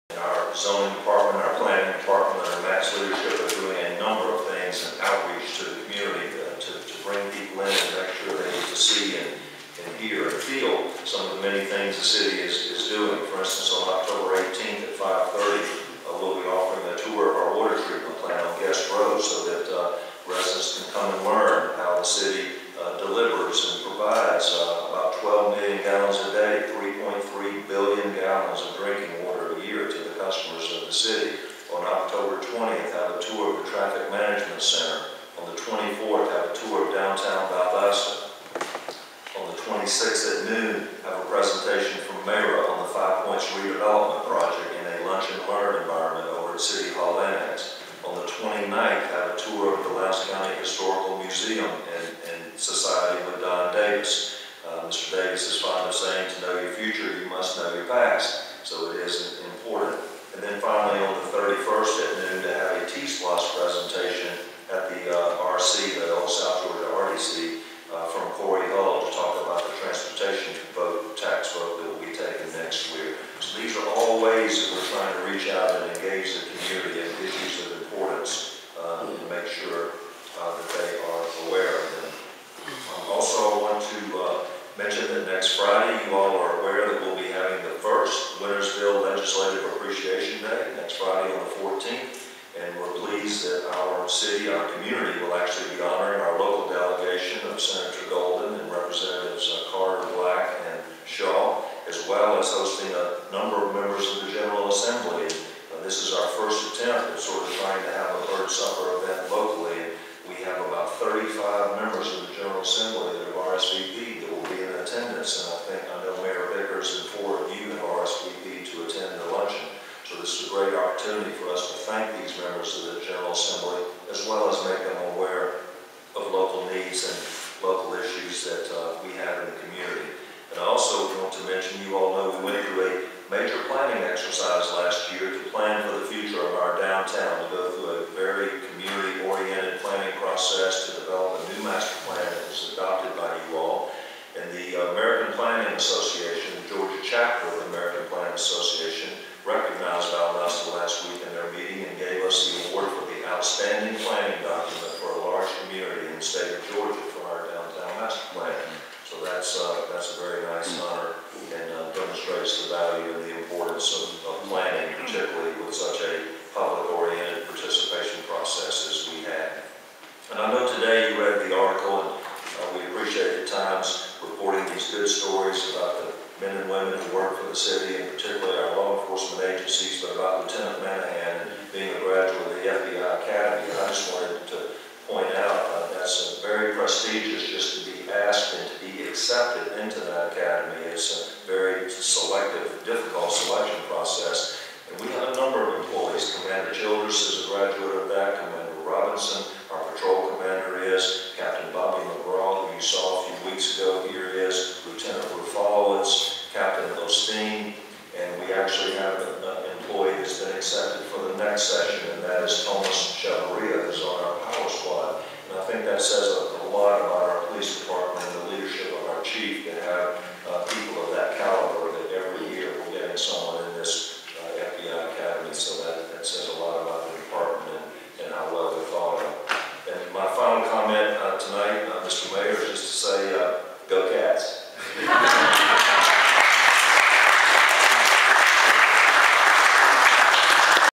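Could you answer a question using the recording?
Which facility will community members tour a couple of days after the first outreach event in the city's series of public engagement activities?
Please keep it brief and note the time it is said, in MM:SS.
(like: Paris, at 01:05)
Traffic Management Center, at 00:33.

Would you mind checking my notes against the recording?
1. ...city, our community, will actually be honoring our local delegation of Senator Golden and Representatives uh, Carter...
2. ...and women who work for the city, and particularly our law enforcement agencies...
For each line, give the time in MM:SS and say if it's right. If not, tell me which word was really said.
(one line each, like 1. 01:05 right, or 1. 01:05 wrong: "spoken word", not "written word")
1. 01:34 right
2. 02:56 right.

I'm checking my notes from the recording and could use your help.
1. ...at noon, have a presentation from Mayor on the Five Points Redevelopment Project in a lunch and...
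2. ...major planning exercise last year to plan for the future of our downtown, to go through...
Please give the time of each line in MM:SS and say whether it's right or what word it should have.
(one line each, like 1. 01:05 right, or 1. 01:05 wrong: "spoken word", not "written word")
1. 00:40 right
2. 02:13 right.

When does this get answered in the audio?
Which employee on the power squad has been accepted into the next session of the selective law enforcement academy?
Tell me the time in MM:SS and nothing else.
03:32.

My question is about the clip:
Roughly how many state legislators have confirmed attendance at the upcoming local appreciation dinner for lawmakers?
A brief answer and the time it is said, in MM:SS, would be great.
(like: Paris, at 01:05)
35, at 01:50.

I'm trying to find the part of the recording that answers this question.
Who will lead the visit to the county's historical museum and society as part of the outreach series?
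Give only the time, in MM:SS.
00:53.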